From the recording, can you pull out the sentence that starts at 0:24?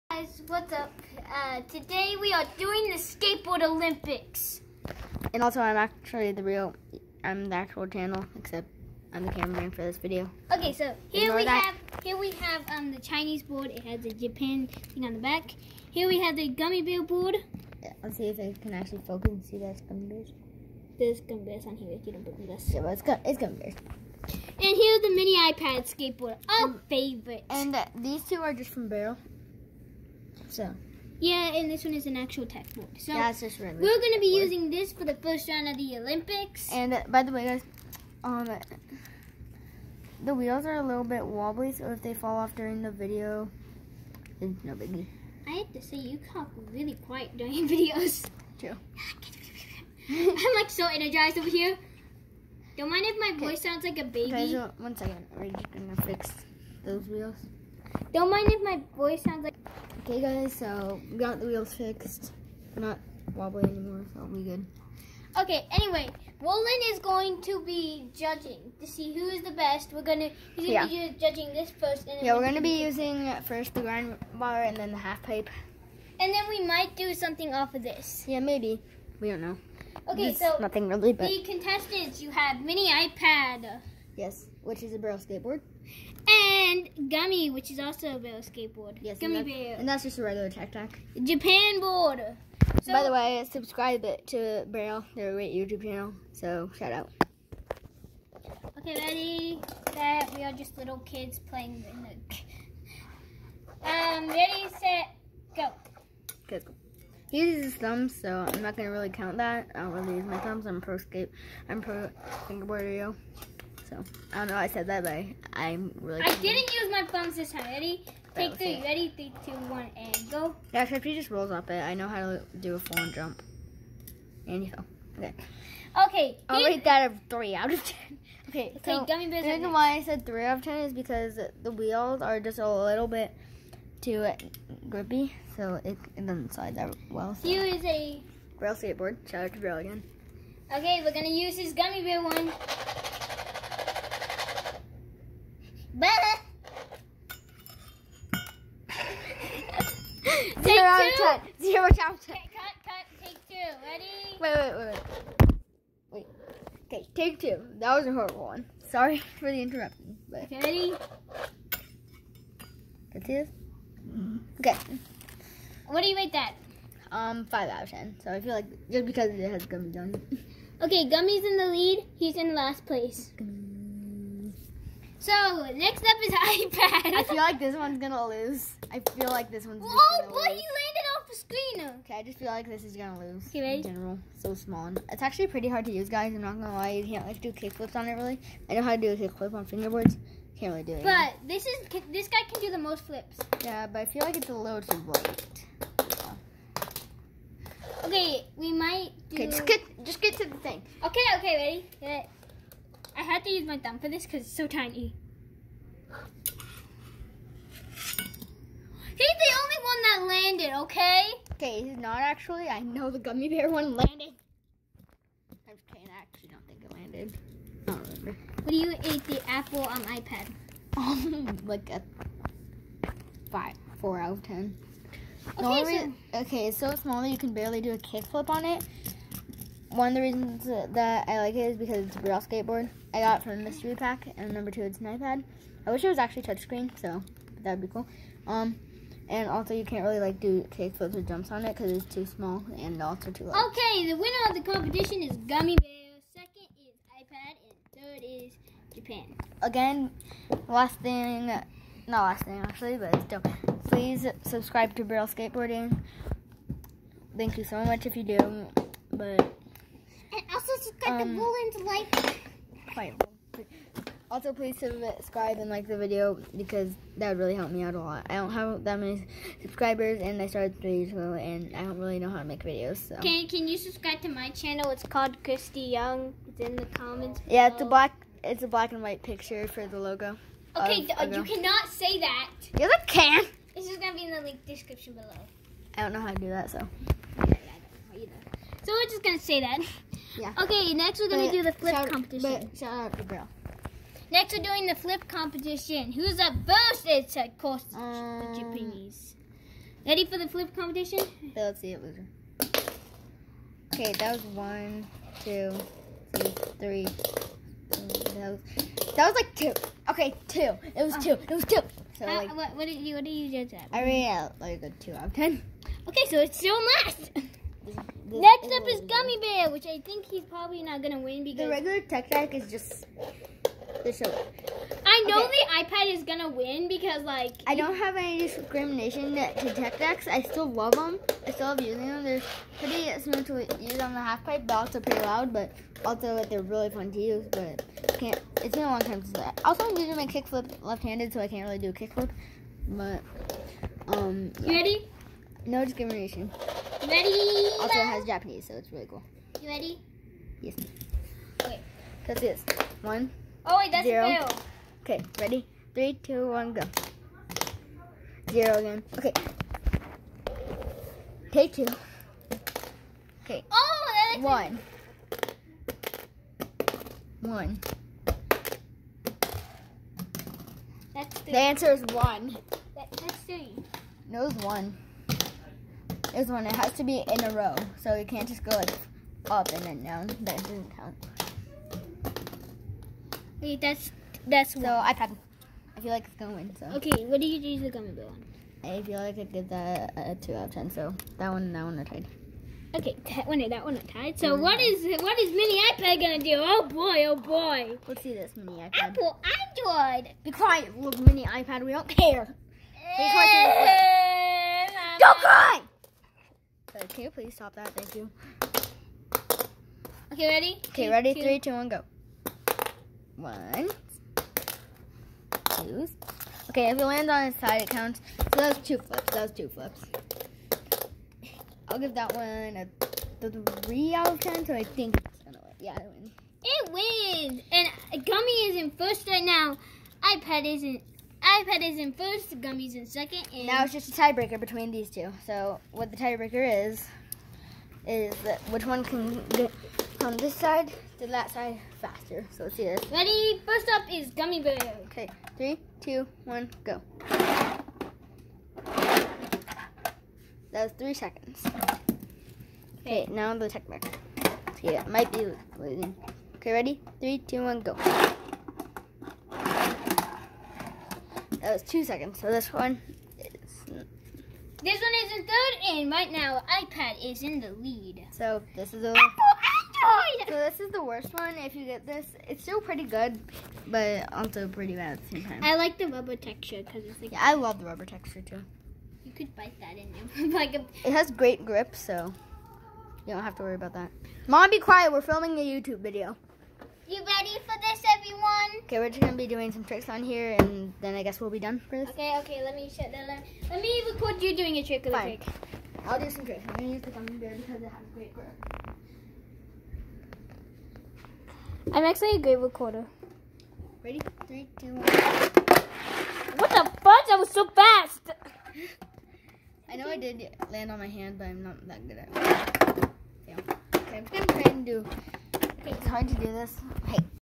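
And here's the mini iPad skateboard, our um, favorite.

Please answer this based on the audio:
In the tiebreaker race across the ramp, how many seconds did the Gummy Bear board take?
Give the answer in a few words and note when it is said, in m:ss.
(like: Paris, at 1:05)
3, at 7:30.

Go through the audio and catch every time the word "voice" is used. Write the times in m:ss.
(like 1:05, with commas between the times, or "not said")
0:53, 0:58.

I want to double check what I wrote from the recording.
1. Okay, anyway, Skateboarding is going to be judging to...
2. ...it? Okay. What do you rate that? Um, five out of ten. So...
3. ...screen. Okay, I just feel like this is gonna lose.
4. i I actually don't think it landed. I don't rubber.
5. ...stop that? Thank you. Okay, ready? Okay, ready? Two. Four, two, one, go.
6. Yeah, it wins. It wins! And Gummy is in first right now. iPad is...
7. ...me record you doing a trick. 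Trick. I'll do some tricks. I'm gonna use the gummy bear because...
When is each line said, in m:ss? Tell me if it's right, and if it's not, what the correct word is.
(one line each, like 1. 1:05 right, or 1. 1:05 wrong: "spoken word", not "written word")
1. 1:05 wrong: "Roland", not "Skateboarding"
2. 2:43 right
3. 3:01 right
4. 3:35 wrong: "remember", not "rubber"
5. 6:47 wrong: "Three", not "Four"
6. 7:05 right
7. 8:13 right.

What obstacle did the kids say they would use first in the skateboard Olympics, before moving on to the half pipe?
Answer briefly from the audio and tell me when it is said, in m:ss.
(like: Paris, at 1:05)
the grind bar, at 1:13.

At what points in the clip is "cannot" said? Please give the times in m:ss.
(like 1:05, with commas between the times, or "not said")
4:41.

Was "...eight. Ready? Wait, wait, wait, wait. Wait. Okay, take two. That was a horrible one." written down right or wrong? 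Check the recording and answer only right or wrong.
wrong.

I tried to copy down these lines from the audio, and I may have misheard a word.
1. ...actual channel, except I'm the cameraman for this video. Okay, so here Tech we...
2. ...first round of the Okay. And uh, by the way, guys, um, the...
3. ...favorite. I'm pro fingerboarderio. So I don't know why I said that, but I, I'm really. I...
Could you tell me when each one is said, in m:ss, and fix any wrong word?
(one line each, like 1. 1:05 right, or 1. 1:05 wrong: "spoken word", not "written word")
1. 0:07 wrong: "Ignore", not "Tech"
2. 0:35 wrong: "Olympics", not "Okay"
3. 1:50 wrong: "skate", not "favorite".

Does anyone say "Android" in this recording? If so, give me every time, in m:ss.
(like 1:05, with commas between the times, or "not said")
6:39, 7:50.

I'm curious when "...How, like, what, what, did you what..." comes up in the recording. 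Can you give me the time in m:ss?
5:12.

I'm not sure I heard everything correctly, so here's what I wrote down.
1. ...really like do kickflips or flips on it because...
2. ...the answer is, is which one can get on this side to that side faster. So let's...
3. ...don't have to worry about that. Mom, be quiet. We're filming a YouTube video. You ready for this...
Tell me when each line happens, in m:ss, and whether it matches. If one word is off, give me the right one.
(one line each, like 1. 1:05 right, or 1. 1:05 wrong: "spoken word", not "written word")
1. 4:00 wrong: "jumps", not "flips"
2. 7:16 wrong: "tiebreaker", not "answer"
3. 8:03 right.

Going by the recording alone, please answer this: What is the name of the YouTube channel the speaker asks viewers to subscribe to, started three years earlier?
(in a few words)
Christy Young.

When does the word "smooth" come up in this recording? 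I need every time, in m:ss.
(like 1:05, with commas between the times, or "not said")
5:33.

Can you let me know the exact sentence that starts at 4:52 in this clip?
But shout out to Next we're doing the flip competition.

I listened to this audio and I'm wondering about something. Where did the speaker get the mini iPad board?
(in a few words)
mystery pack.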